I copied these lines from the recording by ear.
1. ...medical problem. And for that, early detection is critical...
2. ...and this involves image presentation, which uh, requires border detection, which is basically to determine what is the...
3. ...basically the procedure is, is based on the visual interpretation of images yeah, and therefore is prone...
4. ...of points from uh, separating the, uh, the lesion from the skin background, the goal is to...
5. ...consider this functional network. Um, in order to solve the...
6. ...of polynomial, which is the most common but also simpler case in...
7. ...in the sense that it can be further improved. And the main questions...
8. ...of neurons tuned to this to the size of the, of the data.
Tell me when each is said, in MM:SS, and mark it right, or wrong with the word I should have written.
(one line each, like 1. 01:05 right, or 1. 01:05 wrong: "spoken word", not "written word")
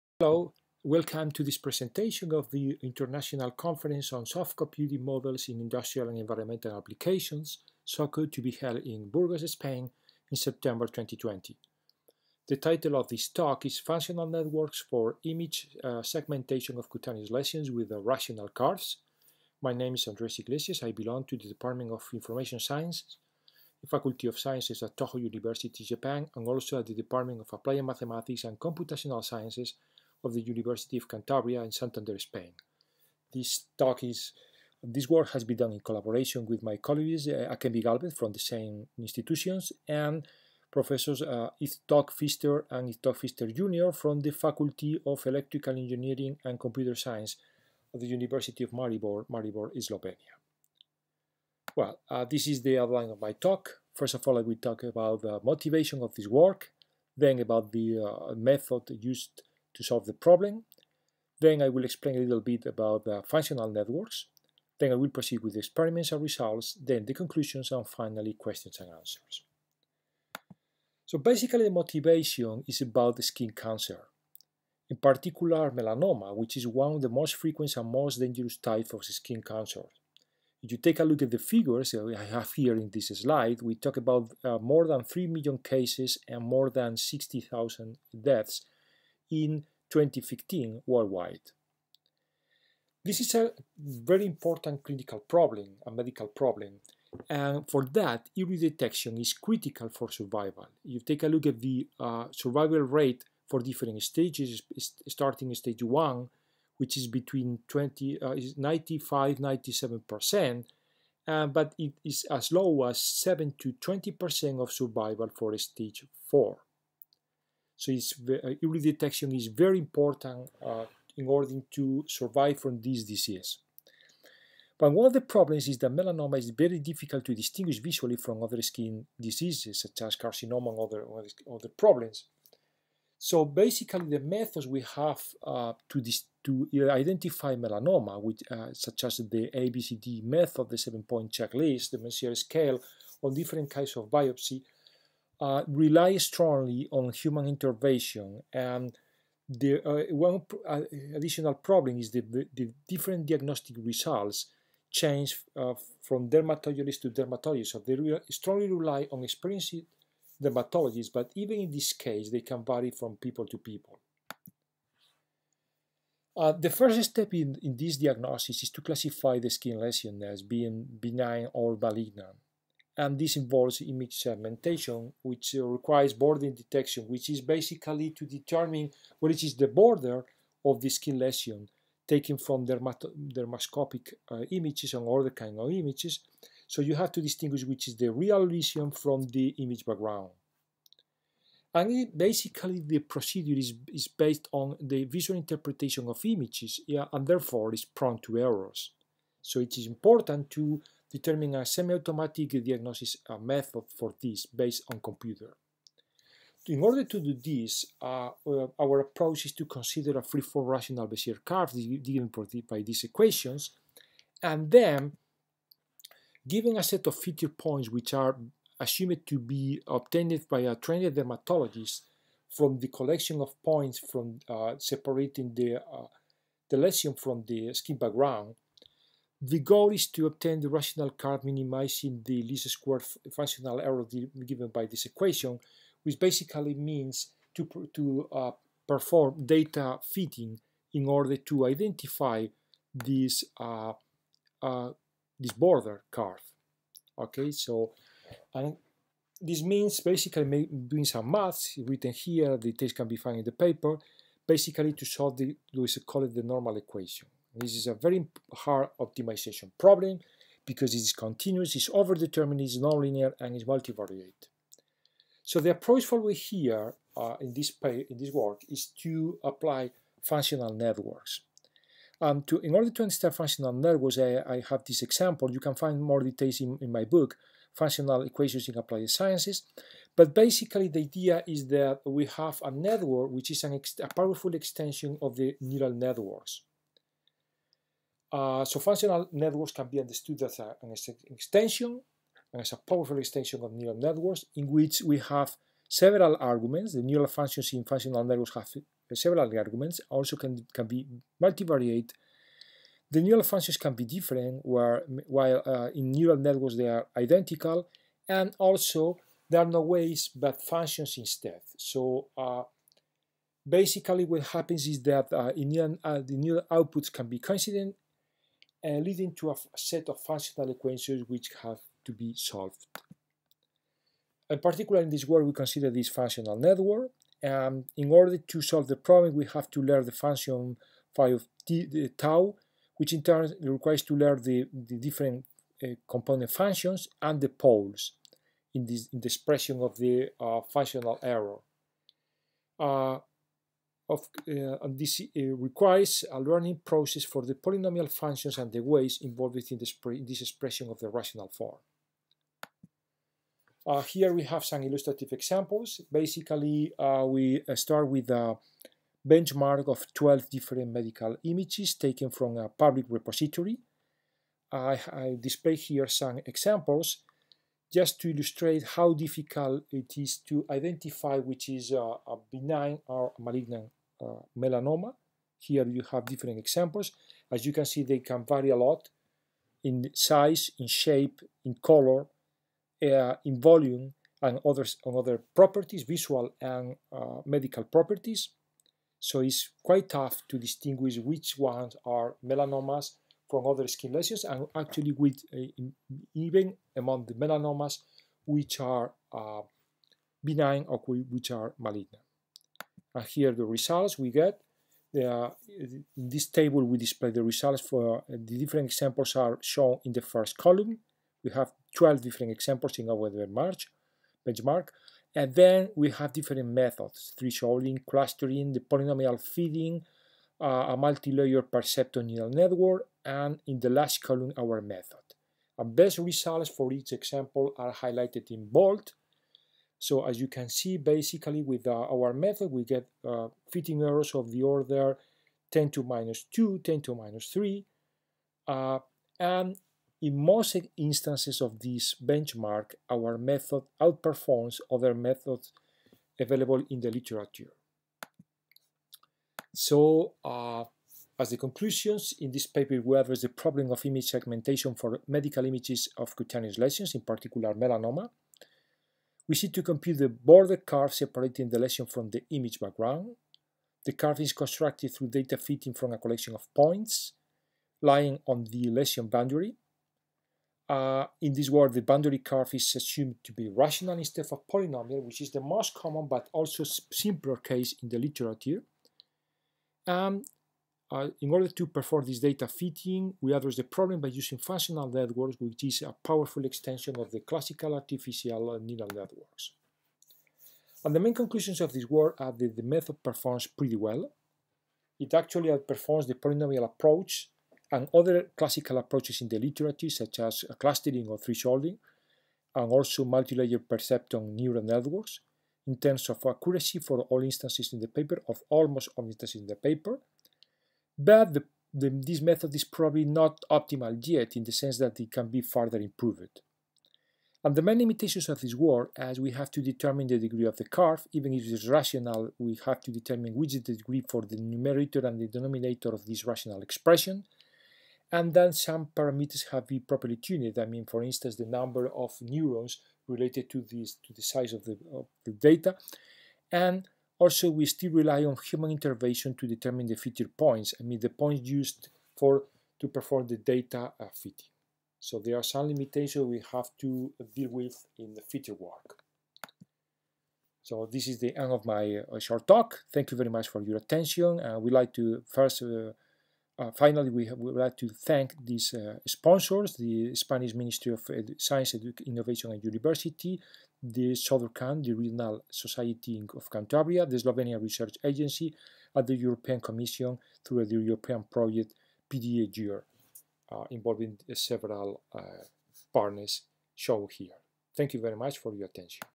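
1. 01:35 right
2. 02:52 wrong: "segmentation", not "presentation"
3. 03:12 right
4. 03:43 right
5. 05:25 right
6. 07:54 right
7. 08:34 wrong: "limitations", not "questions"
8. 08:52 wrong: "related", not "tuned".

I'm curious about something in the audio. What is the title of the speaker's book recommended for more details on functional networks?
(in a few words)
Functional Equations in Applied Sciences.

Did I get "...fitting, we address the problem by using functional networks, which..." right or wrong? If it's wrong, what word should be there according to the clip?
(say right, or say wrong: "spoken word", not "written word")
right.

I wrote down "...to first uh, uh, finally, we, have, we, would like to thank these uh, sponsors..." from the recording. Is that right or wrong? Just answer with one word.
right.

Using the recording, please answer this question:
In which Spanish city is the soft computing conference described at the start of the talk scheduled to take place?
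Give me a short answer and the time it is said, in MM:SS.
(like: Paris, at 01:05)
Burgos, at 00:09.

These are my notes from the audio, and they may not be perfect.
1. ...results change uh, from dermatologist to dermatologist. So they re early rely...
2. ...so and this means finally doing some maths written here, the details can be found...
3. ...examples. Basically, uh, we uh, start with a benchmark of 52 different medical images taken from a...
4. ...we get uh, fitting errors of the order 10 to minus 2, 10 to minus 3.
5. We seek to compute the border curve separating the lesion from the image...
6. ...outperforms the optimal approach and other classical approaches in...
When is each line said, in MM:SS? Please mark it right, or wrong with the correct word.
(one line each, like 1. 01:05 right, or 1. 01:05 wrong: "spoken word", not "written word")
1. 02:33 wrong: "strongly", not "early"
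2. 04:07 wrong: "basically", not "finally"
3. 05:55 wrong: "12", not "52"
4. 07:12 right
5. 07:39 right
6. 08:15 wrong: "polynomial", not "optimal".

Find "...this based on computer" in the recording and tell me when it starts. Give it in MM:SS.
03:24.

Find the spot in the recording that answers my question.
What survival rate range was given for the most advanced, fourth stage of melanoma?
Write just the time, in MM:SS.
01:53.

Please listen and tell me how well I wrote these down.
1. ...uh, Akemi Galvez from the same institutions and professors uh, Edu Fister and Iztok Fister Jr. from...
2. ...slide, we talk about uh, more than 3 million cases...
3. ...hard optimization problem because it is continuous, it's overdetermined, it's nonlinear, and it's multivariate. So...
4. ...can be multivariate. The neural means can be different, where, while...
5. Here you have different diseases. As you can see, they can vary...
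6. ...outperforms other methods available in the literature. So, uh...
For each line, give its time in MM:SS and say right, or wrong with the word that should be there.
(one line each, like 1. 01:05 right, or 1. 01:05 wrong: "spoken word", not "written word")
1. 00:37 wrong: "Iztok", not "Edu"
2. 01:23 right
3. 04:18 right
4. 05:00 wrong: "functions", not "means"
5. 06:15 wrong: "examples", not "diseases"
6. 07:24 right.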